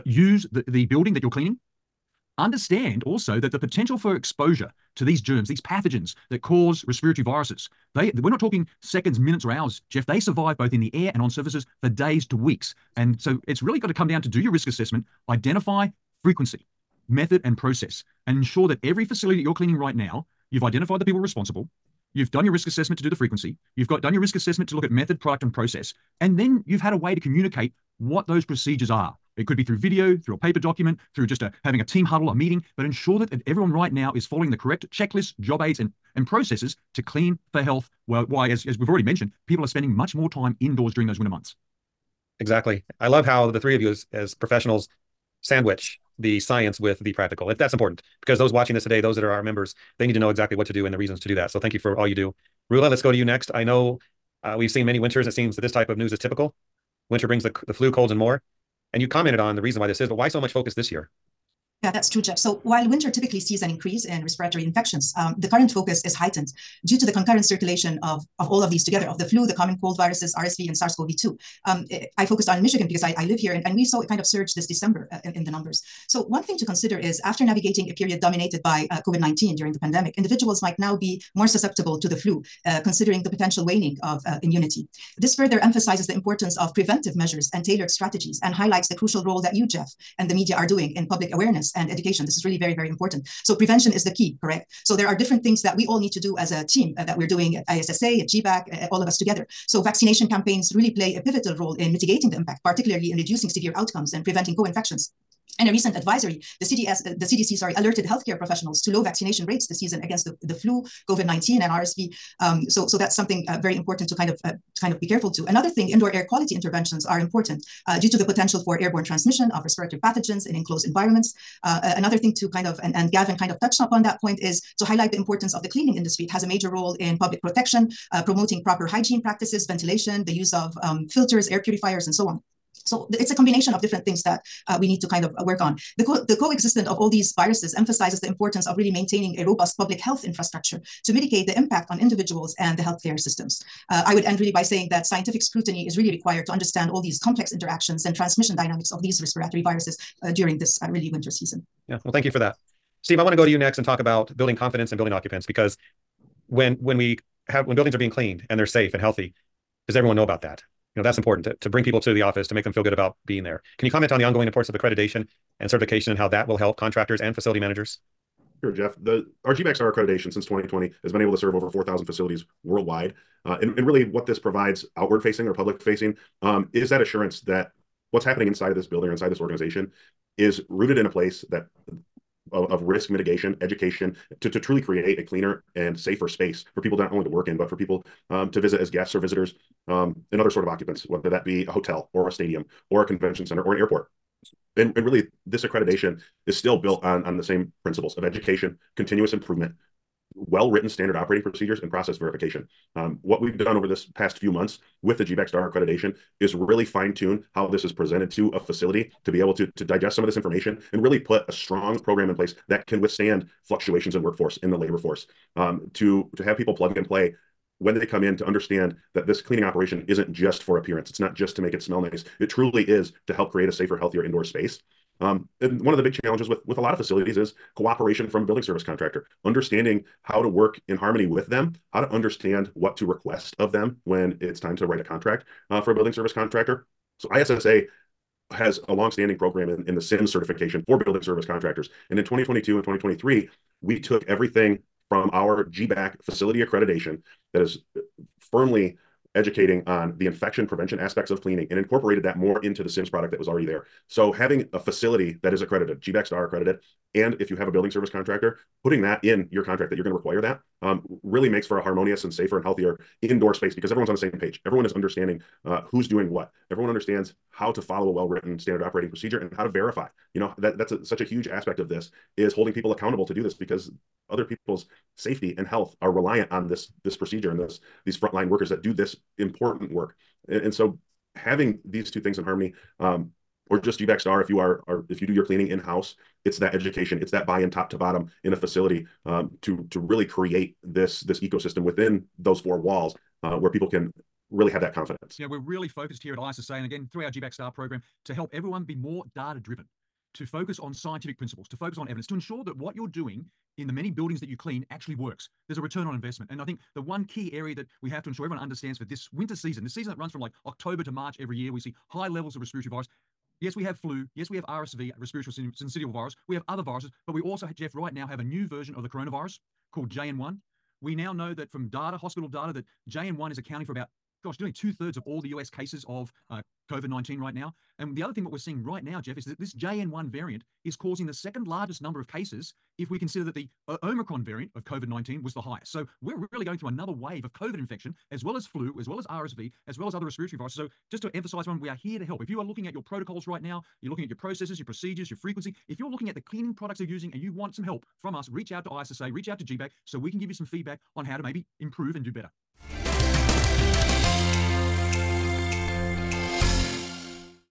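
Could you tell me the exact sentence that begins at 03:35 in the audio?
Um, to have people plug and play when they come in to understand that this cleaning operation isn't just for appearance.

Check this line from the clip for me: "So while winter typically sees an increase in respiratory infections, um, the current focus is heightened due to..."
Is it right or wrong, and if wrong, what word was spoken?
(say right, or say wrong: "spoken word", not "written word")
right.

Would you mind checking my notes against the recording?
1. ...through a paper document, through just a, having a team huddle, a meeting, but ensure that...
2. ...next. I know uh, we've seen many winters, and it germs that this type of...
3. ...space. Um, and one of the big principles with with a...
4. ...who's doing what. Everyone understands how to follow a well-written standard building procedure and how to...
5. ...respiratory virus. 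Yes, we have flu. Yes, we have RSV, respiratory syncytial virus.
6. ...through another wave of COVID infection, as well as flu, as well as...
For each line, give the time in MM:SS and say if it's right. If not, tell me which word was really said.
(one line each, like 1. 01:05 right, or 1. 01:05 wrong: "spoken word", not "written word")
1. 00:30 right
2. 00:53 wrong: "seems", not "germs"
3. 03:44 wrong: "challenges", not "principles"
4. 04:25 wrong: "operating", not "building"
5. 05:12 right
6. 05:36 right.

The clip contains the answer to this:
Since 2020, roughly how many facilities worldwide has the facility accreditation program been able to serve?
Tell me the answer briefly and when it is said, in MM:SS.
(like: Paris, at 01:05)
over 4,000, at 02:51.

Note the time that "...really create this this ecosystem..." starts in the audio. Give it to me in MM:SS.
04:49.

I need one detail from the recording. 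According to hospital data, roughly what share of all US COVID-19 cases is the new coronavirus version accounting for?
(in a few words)
two thirds.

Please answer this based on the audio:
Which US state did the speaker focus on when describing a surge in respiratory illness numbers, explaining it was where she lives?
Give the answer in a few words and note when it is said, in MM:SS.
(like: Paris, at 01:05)
Michigan, at 01:12.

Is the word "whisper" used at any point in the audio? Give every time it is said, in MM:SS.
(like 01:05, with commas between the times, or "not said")
not said.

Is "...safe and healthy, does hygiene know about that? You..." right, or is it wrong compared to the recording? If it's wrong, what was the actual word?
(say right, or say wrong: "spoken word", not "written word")
wrong: "everyone", not "hygiene".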